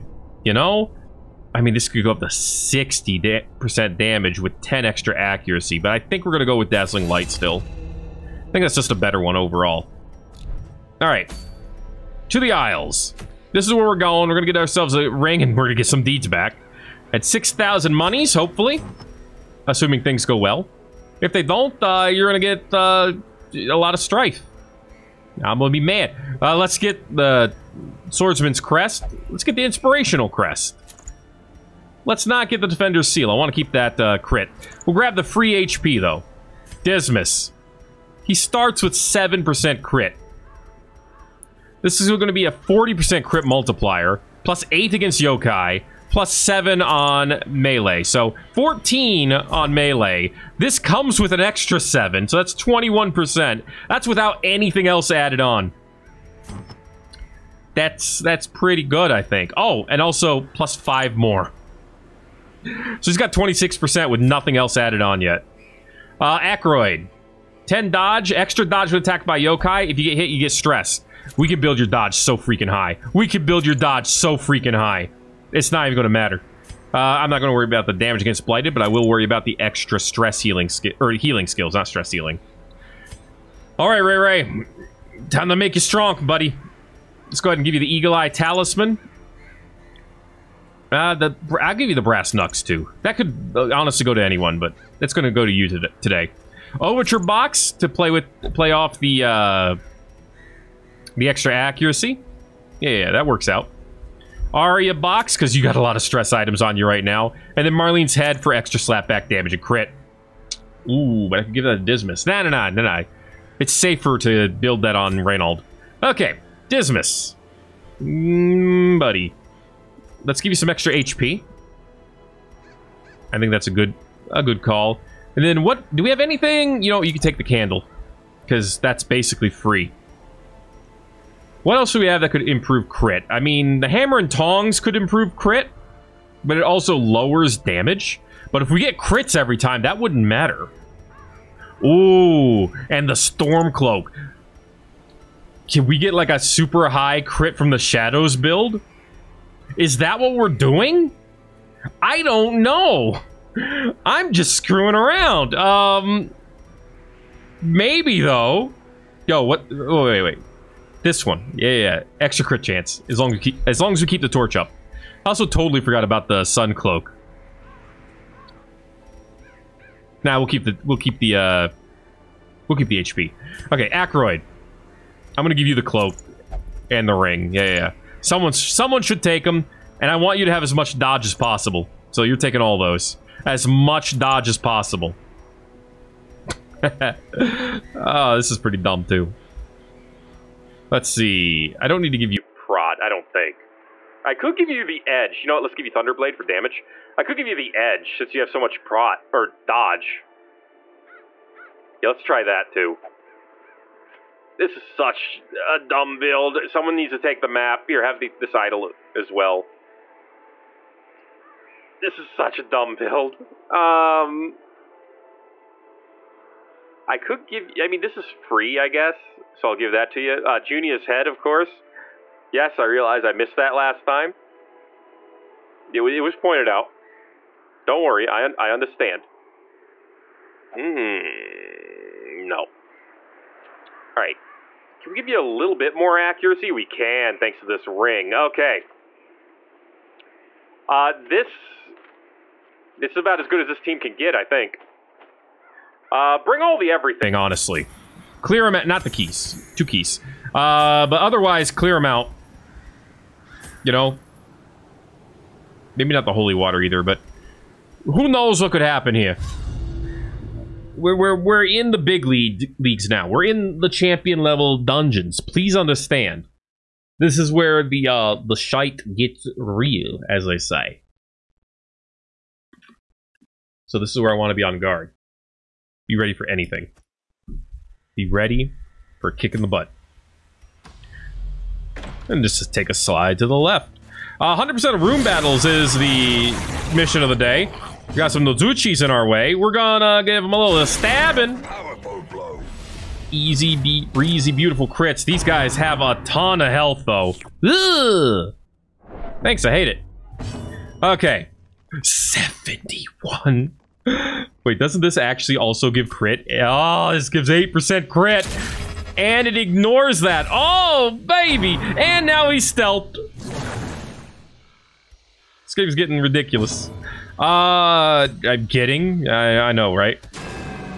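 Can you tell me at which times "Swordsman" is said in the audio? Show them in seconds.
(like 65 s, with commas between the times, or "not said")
28 s.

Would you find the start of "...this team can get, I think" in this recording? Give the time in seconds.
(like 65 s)
243 s.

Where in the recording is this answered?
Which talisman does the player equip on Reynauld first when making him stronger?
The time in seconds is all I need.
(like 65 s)
87 s.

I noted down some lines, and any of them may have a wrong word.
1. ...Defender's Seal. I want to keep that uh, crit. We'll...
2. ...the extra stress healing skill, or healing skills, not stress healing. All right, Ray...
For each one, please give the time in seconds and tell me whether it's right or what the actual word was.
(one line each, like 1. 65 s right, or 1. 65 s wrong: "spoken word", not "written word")
1. 32 s right
2. 79 s right.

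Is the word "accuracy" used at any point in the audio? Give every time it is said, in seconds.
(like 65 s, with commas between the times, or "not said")
5 s, 101 s, 236 s.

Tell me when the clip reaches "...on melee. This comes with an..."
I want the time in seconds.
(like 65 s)
49 s.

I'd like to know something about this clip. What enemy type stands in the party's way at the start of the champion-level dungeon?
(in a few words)
Nozuchis.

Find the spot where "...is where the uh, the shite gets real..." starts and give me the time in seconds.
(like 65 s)
267 s.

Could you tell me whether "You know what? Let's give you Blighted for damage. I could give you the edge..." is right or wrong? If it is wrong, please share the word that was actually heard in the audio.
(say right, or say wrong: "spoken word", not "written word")
wrong: "Thunderblade", not "Blighted".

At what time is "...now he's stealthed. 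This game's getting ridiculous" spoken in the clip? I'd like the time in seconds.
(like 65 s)
312 s.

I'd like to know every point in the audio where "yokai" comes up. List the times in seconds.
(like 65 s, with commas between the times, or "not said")
45 s, 69 s.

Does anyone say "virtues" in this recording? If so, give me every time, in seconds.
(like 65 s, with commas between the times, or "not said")
not said.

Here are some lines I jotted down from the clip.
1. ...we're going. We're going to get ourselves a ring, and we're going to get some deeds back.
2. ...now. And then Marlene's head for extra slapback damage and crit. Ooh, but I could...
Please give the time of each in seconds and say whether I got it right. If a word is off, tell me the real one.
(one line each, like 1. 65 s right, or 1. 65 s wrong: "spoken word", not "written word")
1. 13 s right
2. 107 s right.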